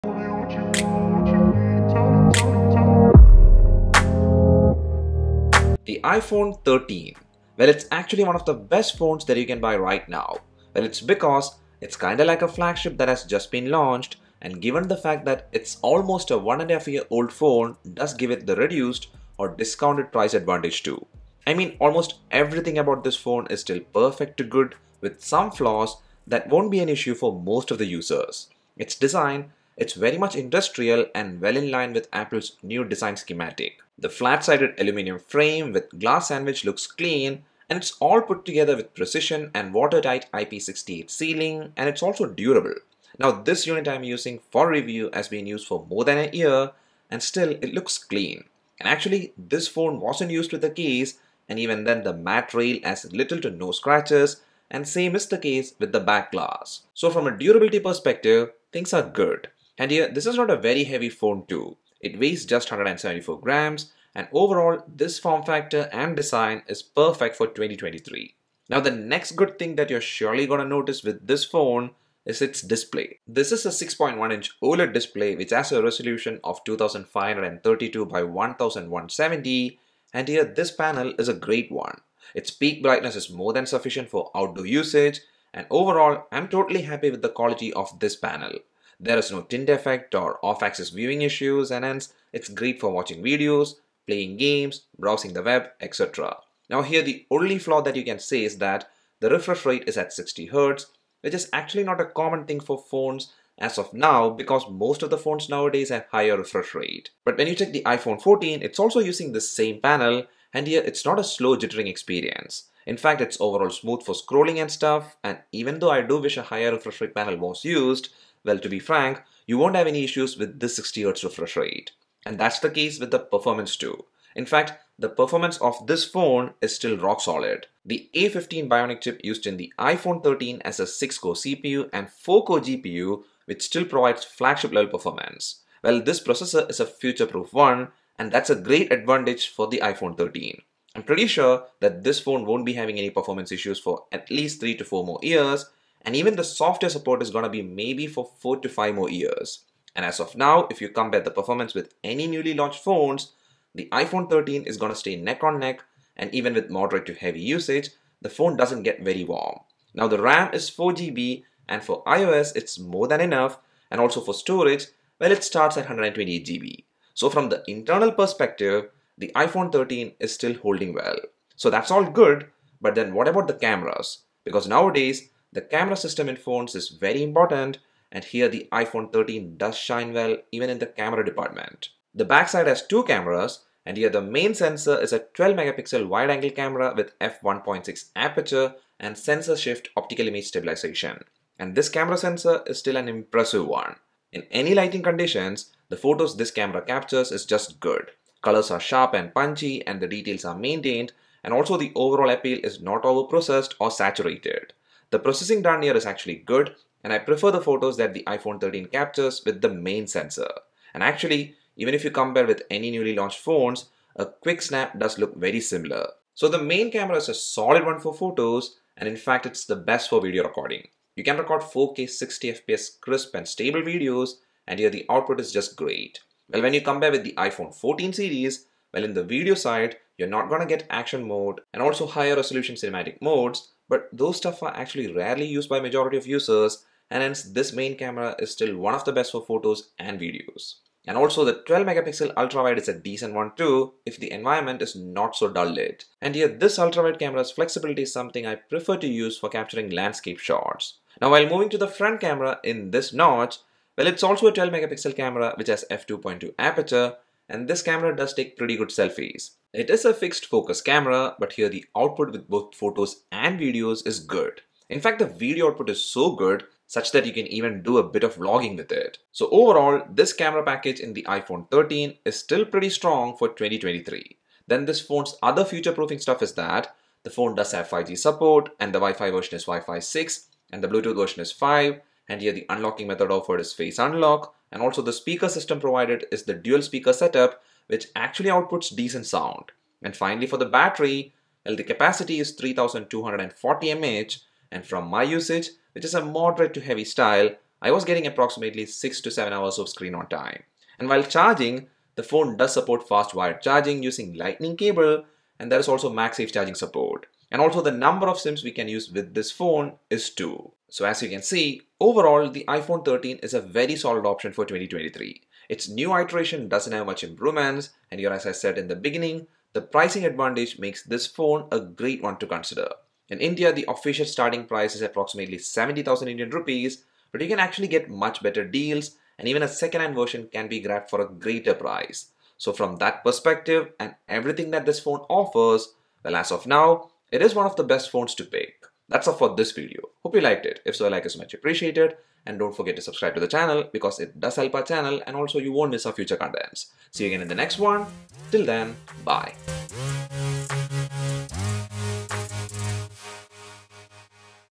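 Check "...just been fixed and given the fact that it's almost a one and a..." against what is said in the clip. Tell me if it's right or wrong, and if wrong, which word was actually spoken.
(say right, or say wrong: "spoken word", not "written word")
wrong: "launched", not "fixed".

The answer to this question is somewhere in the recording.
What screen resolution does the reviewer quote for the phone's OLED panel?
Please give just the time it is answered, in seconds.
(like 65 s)
76 s.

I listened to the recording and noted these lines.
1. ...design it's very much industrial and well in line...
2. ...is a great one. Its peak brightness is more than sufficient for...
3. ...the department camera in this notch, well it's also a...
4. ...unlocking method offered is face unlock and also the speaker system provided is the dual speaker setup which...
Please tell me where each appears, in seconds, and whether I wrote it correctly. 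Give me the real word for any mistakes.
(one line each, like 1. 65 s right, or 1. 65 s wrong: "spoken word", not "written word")
1. 28 s right
2. 81 s right
3. 251 s wrong: "front", not "department"
4. 282 s right.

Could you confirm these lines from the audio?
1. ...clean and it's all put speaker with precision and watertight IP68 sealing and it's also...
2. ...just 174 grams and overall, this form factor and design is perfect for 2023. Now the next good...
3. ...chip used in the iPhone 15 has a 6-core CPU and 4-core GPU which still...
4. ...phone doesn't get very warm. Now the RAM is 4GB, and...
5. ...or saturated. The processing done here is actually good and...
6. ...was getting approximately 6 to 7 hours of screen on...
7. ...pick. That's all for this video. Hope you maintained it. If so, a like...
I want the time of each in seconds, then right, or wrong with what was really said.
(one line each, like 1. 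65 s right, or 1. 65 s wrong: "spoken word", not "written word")
1. 36 s wrong: "together", not "speaker"
2. 62 s right
3. 129 s wrong: "13", not "15"
4. 158 s right
5. 203 s right
6. 297 s right
7. 338 s wrong: "liked", not "maintained".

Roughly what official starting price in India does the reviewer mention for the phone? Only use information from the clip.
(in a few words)
70,000 Indian rupees.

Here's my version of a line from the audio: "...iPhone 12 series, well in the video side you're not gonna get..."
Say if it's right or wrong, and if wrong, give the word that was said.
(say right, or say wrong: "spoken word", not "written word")
wrong: "14", not "12".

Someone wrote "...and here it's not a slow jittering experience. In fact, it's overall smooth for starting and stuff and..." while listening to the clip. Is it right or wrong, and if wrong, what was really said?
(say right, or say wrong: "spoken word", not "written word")
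wrong: "scrolling", not "starting".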